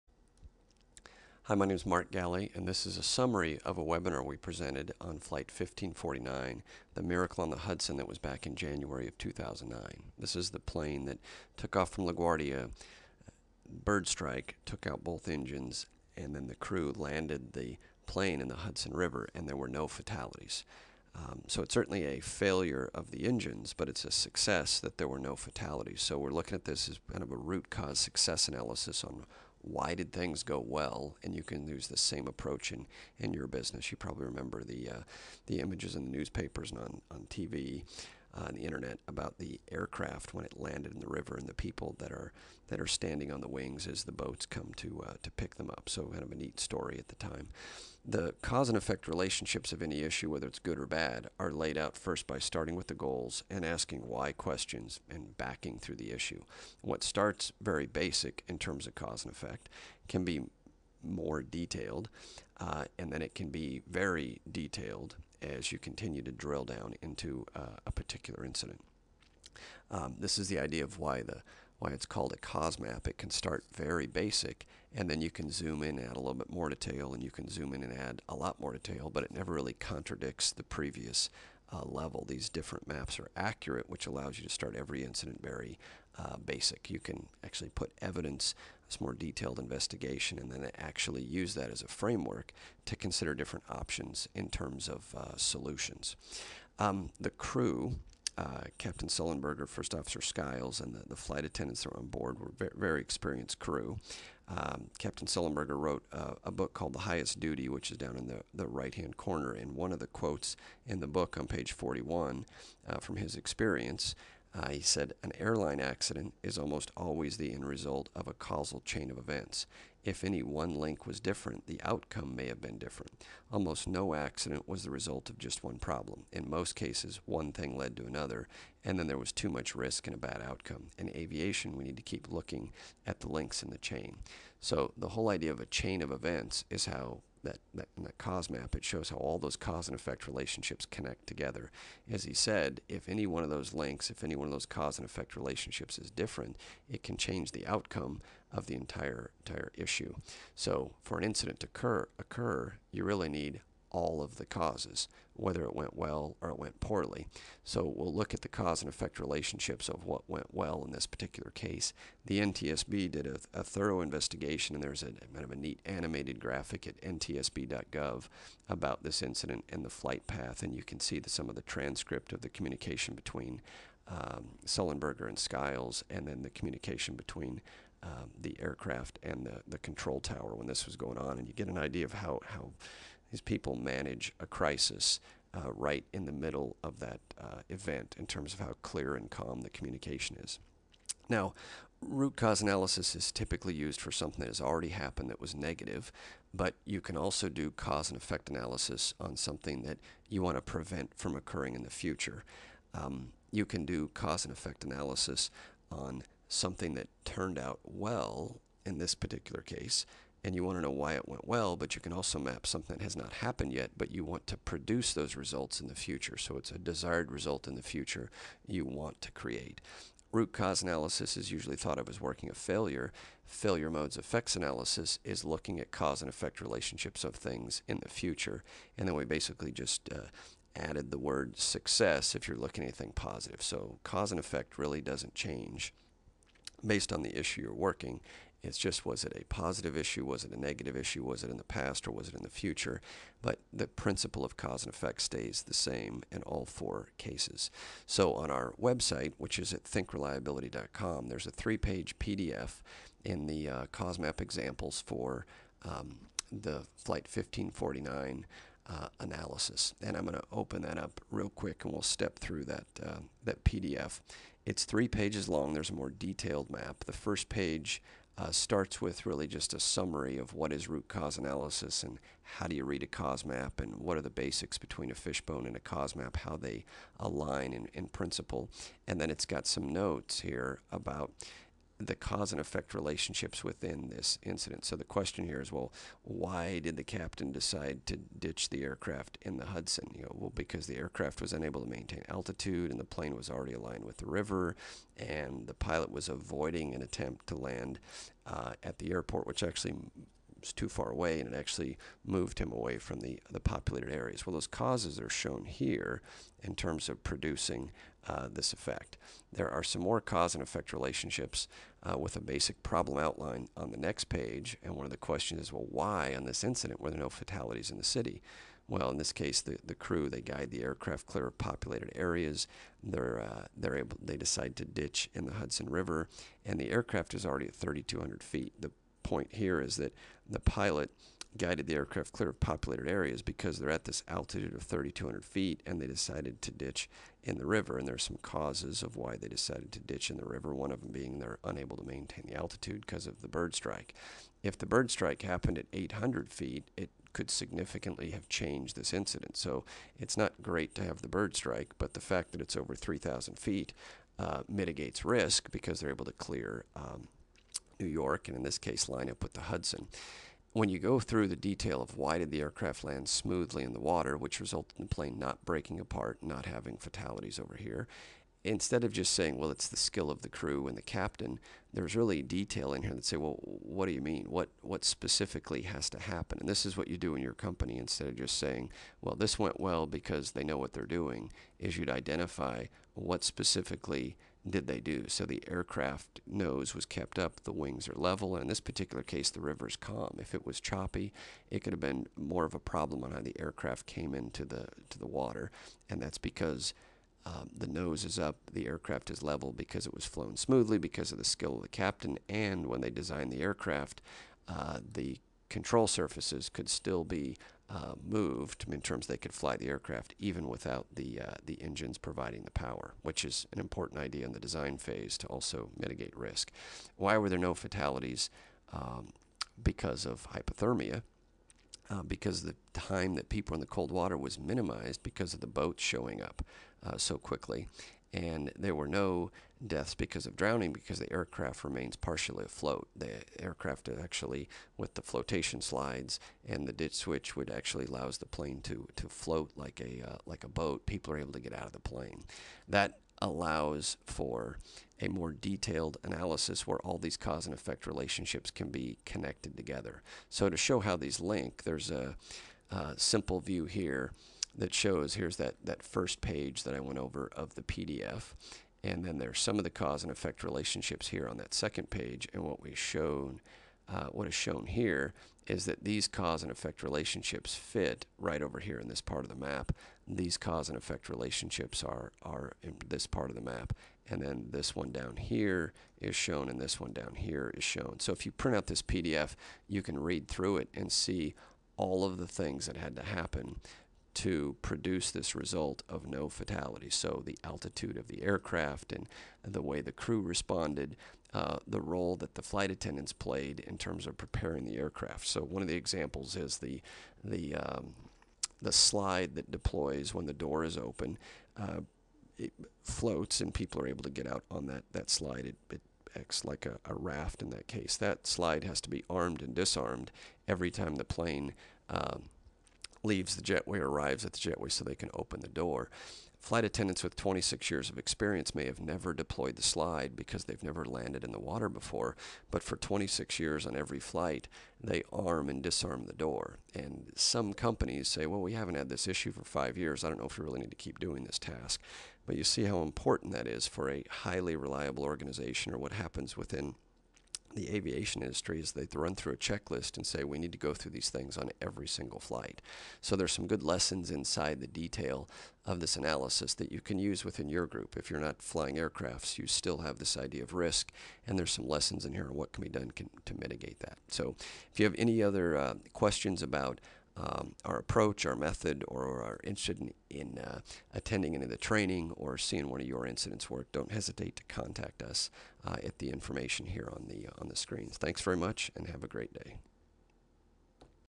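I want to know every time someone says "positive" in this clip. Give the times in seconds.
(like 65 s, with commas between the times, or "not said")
233 s, 239 s.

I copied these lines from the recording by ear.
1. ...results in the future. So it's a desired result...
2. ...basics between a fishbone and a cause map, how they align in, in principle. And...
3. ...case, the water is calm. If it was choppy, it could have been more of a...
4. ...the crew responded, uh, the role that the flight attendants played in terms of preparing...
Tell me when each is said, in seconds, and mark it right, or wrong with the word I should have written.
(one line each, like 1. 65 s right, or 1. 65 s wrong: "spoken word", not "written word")
1. 215 s right
2. 274 s right
3. 389 s wrong: "river", not "water"
4. 490 s right.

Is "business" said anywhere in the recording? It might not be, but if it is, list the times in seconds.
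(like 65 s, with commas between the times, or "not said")
33 s.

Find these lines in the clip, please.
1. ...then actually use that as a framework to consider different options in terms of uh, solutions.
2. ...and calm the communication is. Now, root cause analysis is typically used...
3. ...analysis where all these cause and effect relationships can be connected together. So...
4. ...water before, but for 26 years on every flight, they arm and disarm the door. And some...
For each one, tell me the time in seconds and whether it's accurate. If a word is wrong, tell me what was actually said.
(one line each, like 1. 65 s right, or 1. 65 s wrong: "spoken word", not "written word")
1. 90 s right
2. 189 s right
3. 446 s right
4. 521 s right.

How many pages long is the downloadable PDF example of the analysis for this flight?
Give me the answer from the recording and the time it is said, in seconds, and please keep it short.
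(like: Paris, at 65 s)
3, at 251 s.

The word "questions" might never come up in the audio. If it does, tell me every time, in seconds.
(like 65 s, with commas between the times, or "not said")
54 s, 285 s, 315 s, 556 s.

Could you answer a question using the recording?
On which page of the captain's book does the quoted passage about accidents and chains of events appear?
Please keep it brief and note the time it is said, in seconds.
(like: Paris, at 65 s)
41, at 111 s.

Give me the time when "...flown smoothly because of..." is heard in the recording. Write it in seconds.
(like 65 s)
400 s.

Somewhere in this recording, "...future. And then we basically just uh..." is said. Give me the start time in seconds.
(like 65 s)
228 s.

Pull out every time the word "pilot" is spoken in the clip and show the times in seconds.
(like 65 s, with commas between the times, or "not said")
295 s, 330 s.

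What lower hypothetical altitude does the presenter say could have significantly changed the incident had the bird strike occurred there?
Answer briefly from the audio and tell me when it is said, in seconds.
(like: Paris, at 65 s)
800 feet, at 345 s.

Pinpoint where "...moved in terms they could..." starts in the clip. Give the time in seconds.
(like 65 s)
408 s.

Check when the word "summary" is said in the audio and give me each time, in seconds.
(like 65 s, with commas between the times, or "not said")
3 s, 269 s.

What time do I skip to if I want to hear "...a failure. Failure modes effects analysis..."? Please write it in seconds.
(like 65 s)
222 s.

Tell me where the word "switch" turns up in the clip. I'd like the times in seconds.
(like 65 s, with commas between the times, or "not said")
437 s.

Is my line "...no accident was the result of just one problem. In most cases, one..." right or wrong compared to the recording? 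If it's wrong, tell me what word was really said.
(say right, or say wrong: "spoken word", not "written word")
right.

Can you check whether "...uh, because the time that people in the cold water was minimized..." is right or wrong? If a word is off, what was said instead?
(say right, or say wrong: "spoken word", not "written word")
right.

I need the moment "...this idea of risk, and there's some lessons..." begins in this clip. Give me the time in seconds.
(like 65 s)
550 s.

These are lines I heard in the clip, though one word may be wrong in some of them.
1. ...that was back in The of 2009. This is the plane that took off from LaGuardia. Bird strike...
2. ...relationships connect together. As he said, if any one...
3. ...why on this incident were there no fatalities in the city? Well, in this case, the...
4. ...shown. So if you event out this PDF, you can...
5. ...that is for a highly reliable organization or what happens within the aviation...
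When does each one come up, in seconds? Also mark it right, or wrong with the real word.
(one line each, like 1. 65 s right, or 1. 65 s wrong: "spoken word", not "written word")
1. 7 s wrong: "January", not "The"
2. 140 s right
3. 315 s right
4. 477 s wrong: "print", not "event"
5. 533 s right.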